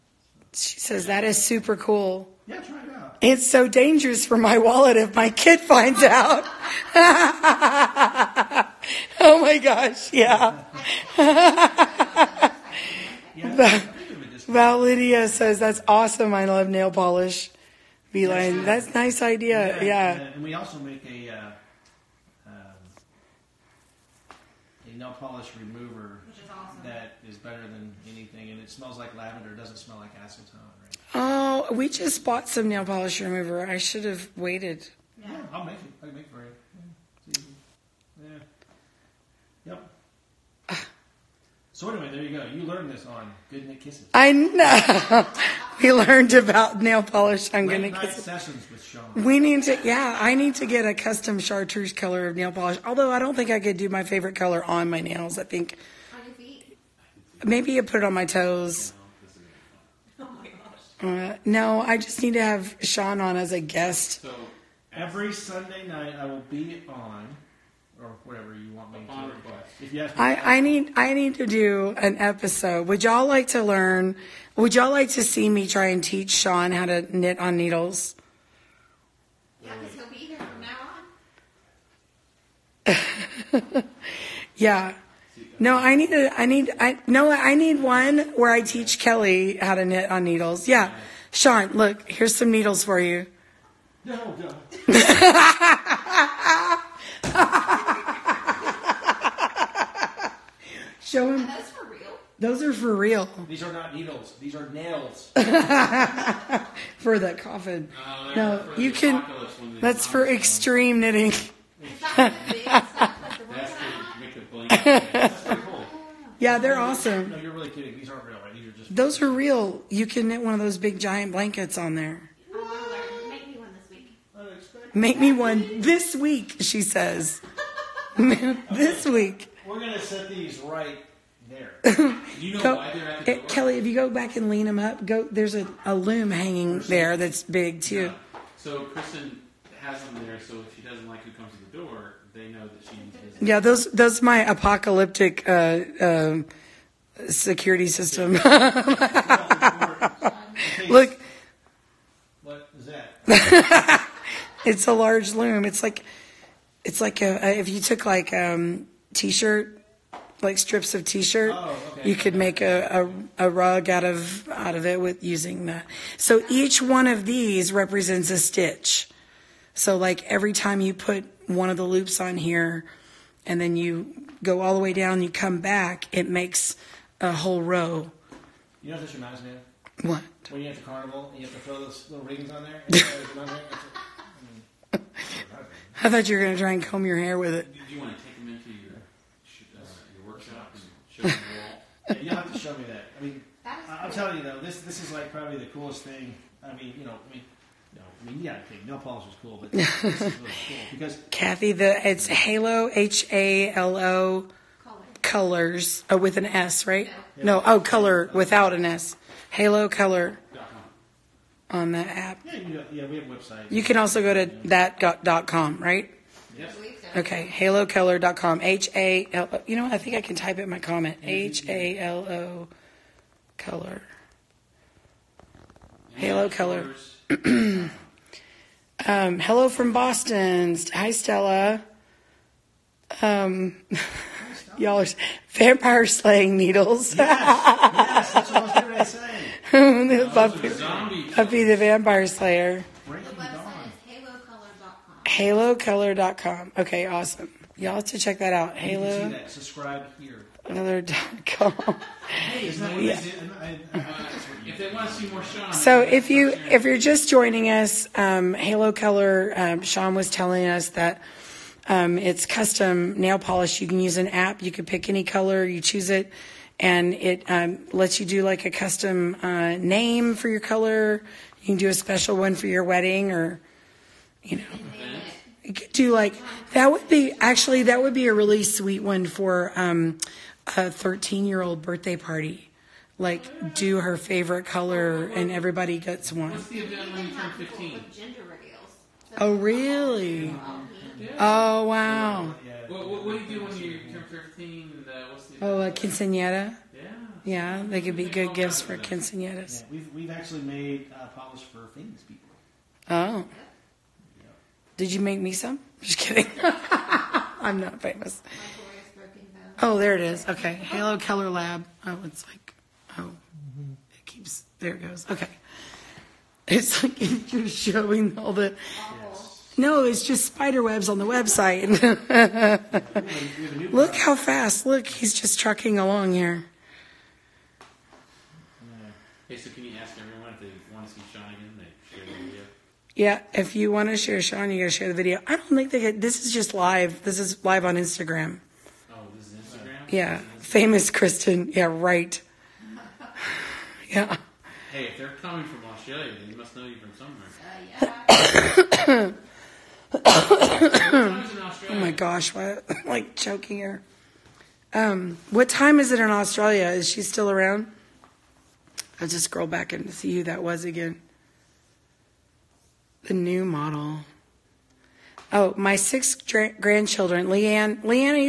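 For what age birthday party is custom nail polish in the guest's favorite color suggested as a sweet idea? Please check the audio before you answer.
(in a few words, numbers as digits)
13.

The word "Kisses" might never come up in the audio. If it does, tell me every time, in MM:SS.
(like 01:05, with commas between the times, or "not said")
00:43, 00:47.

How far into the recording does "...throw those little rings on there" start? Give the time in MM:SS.
03:01.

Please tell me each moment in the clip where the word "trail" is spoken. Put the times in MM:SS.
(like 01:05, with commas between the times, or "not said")
not said.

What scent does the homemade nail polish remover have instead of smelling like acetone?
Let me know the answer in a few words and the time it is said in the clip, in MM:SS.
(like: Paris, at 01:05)
lavender, at 00:29.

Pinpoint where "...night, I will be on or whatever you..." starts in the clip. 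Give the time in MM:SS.
01:05.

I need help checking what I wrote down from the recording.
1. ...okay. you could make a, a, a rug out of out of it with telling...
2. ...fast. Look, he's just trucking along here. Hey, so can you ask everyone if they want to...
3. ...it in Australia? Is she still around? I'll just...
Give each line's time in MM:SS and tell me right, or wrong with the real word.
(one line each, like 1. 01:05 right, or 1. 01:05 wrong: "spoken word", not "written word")
1. 02:41 wrong: "using", not "telling"
2. 05:24 right
3. 05:56 right.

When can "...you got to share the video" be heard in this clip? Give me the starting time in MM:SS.
05:34.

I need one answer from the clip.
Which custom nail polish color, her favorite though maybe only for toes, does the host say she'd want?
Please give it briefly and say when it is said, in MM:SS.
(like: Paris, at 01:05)
chartreuse, at 00:51.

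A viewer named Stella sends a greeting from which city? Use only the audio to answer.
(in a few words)
Boston.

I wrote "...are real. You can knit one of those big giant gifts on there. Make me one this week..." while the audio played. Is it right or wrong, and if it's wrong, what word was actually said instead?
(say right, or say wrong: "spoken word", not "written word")
wrong: "blankets", not "gifts".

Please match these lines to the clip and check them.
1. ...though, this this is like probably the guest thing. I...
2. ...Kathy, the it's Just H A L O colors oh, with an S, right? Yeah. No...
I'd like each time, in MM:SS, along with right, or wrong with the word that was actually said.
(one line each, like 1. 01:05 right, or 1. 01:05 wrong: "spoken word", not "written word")
1. 03:14 wrong: "coolest", not "guest"
2. 03:21 wrong: "Halo", not "Just".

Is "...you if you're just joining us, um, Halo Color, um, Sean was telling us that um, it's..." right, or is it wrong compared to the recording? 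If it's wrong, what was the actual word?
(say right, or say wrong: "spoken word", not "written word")
right.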